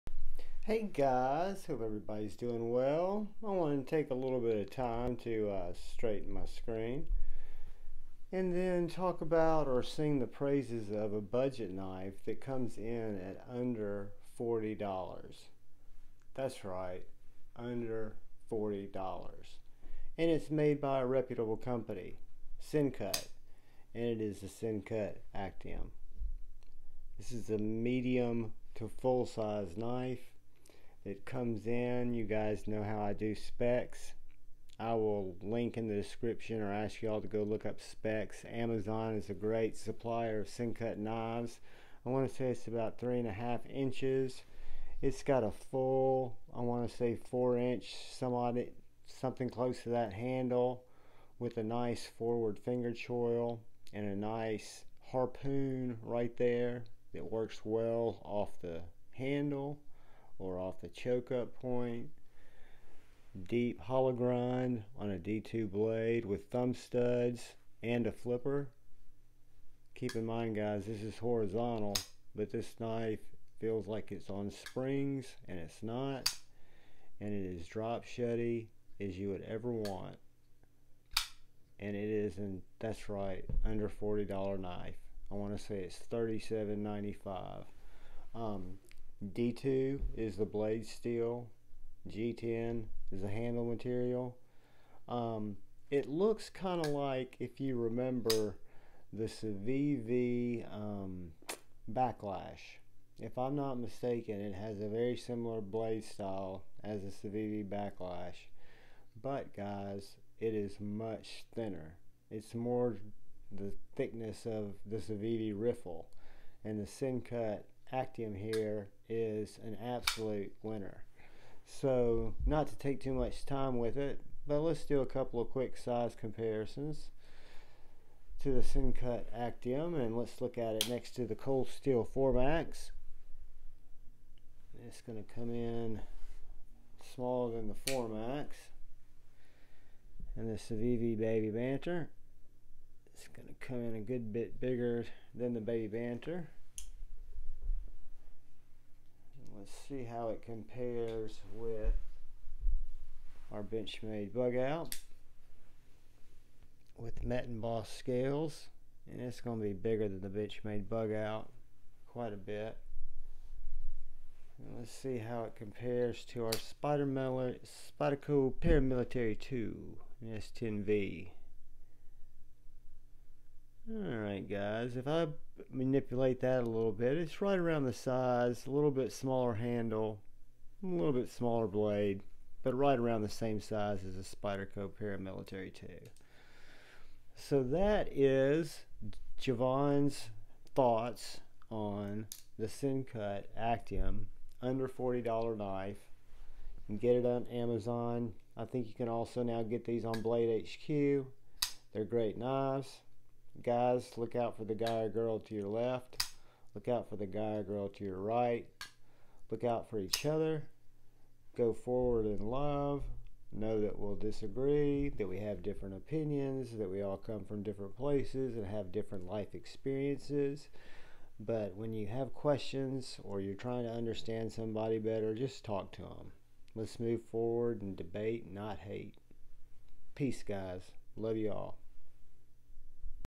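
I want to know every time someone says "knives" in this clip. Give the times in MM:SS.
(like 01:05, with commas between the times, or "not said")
00:40, 03:22.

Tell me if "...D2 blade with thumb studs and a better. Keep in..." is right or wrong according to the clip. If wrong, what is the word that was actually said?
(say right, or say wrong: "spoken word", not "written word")
wrong: "flipper", not "better".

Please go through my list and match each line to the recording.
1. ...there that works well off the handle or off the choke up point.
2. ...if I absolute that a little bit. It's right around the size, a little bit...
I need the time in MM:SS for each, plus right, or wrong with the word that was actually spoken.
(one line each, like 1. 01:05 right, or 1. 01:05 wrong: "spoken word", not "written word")
1. 00:56 right
2. 02:54 wrong: "manipulate", not "absolute".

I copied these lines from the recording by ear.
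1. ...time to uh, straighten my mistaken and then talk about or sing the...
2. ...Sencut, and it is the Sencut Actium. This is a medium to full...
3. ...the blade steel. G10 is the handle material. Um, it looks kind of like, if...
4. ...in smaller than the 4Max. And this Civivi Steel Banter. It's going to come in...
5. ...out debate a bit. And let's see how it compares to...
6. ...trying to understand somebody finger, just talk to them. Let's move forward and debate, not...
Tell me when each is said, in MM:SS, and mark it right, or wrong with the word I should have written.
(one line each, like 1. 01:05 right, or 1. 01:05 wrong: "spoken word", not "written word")
1. 00:04 wrong: "screen", not "mistaken"
2. 00:22 right
3. 01:30 right
4. 02:15 wrong: "Baby", not "Steel"
5. 02:41 wrong: "quite", not "debate"
6. 03:43 wrong: "better", not "finger".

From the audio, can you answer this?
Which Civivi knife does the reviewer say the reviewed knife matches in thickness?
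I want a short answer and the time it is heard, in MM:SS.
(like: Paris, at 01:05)
Civivi Riffle, at 01:54.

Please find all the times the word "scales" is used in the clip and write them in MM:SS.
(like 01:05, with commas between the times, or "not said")
02:37.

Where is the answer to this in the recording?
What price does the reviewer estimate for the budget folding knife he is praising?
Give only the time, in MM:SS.
01:26.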